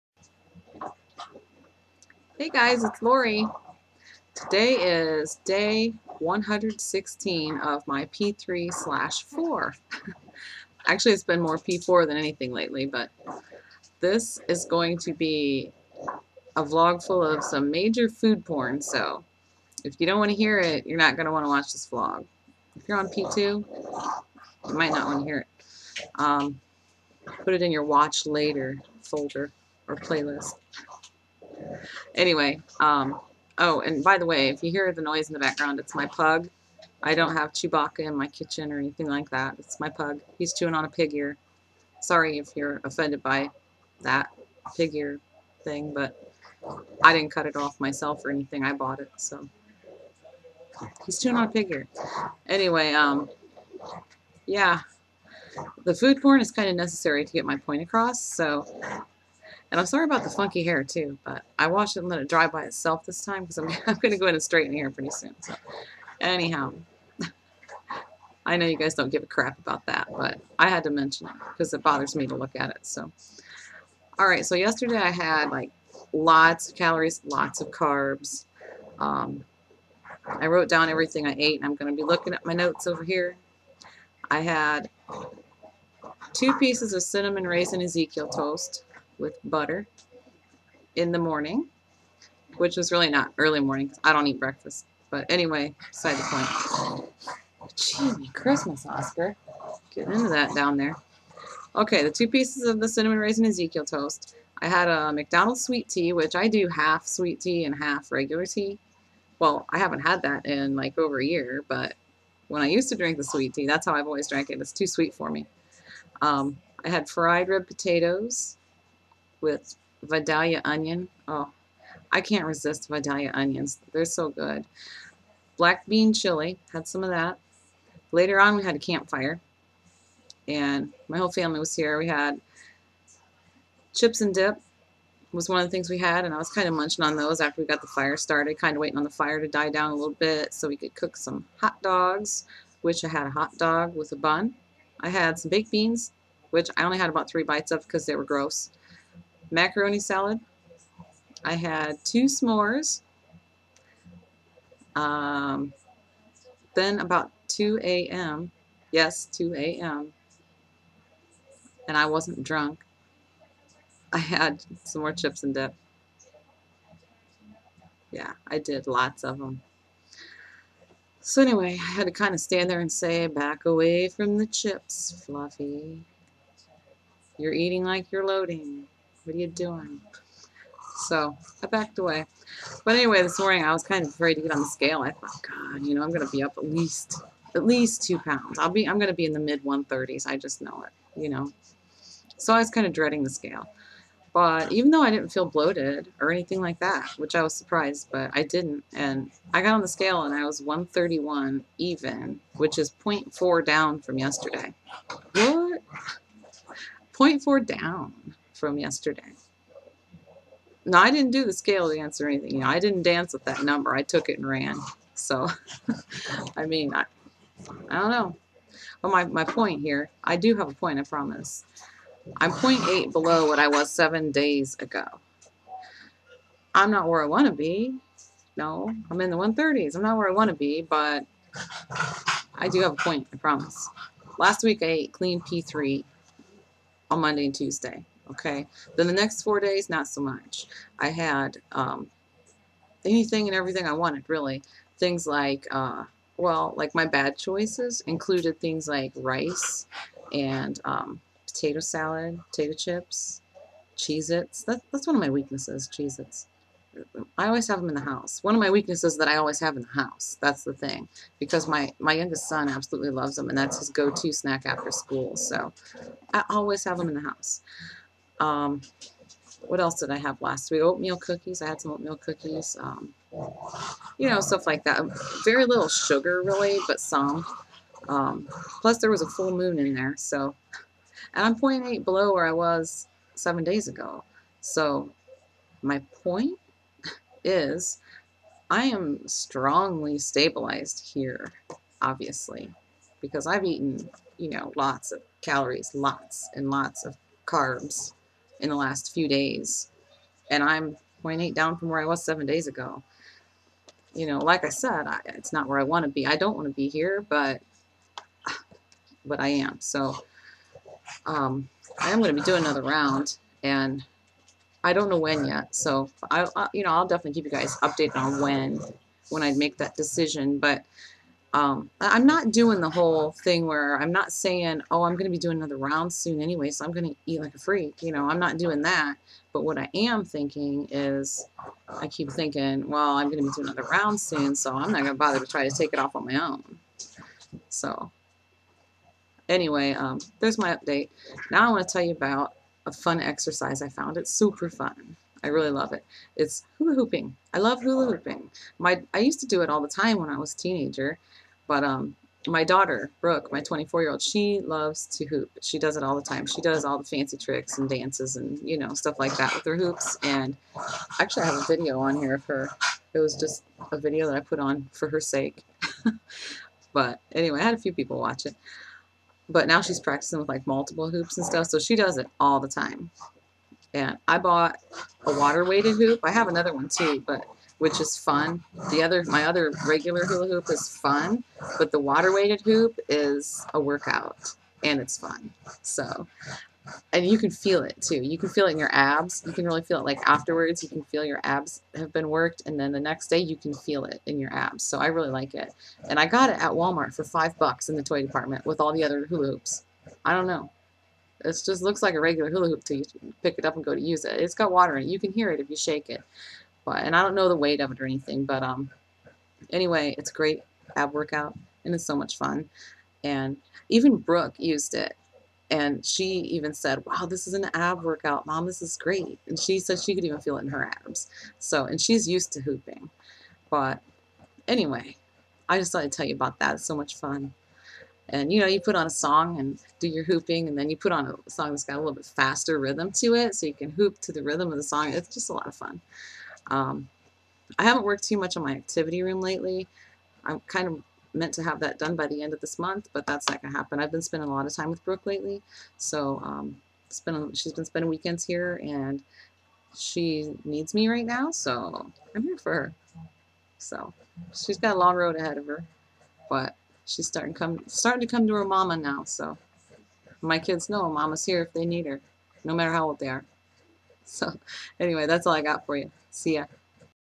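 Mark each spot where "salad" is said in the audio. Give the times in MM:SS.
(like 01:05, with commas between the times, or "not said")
02:29, 04:11.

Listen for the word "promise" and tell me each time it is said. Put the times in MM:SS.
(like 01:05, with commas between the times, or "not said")
03:41, 03:53.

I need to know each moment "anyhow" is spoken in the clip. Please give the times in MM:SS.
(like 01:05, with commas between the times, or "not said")
01:06.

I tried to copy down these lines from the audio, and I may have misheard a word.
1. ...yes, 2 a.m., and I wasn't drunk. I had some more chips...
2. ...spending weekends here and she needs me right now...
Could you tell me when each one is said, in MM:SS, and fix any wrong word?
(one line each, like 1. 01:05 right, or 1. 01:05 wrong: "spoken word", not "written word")
1. 02:38 right
2. 07:27 right.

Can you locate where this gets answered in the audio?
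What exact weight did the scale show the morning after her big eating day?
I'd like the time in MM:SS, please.
03:20.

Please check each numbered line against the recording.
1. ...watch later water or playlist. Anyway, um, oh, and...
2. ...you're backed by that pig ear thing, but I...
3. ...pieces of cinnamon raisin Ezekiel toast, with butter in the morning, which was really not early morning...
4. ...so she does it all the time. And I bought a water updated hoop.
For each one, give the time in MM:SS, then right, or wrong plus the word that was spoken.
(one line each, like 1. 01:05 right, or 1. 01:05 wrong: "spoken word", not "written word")
1. 00:27 wrong: "folder", not "water"
2. 00:42 wrong: "offended", not "backed"
3. 01:26 right
4. 06:11 wrong: "weighted", not "updated".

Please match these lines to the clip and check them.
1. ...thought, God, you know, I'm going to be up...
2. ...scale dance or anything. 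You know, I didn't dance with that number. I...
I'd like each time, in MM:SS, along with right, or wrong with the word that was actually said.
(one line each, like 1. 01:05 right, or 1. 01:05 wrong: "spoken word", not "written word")
1. 03:05 right
2. 03:31 right.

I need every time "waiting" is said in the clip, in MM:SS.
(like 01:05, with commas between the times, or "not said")
02:18.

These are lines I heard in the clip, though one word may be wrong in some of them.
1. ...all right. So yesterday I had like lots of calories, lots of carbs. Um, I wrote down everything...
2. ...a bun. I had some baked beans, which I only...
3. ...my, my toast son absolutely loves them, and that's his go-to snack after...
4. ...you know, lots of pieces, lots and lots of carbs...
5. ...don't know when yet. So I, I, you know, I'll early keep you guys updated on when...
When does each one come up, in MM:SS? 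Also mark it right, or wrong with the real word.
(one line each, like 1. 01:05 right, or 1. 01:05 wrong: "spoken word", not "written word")
1. 01:14 right
2. 02:24 right
3. 04:21 wrong: "youngest", not "toast"
4. 04:54 wrong: "calories", not "pieces"
5. 05:14 wrong: "definitely", not "early".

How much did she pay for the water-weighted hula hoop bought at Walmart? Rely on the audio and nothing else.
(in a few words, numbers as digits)
$5.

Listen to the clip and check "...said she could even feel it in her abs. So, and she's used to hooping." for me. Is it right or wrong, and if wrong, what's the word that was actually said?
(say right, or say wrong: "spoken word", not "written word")
right.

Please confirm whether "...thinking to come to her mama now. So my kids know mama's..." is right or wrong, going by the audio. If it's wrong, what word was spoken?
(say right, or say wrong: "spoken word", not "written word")
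wrong: "starting", not "thinking".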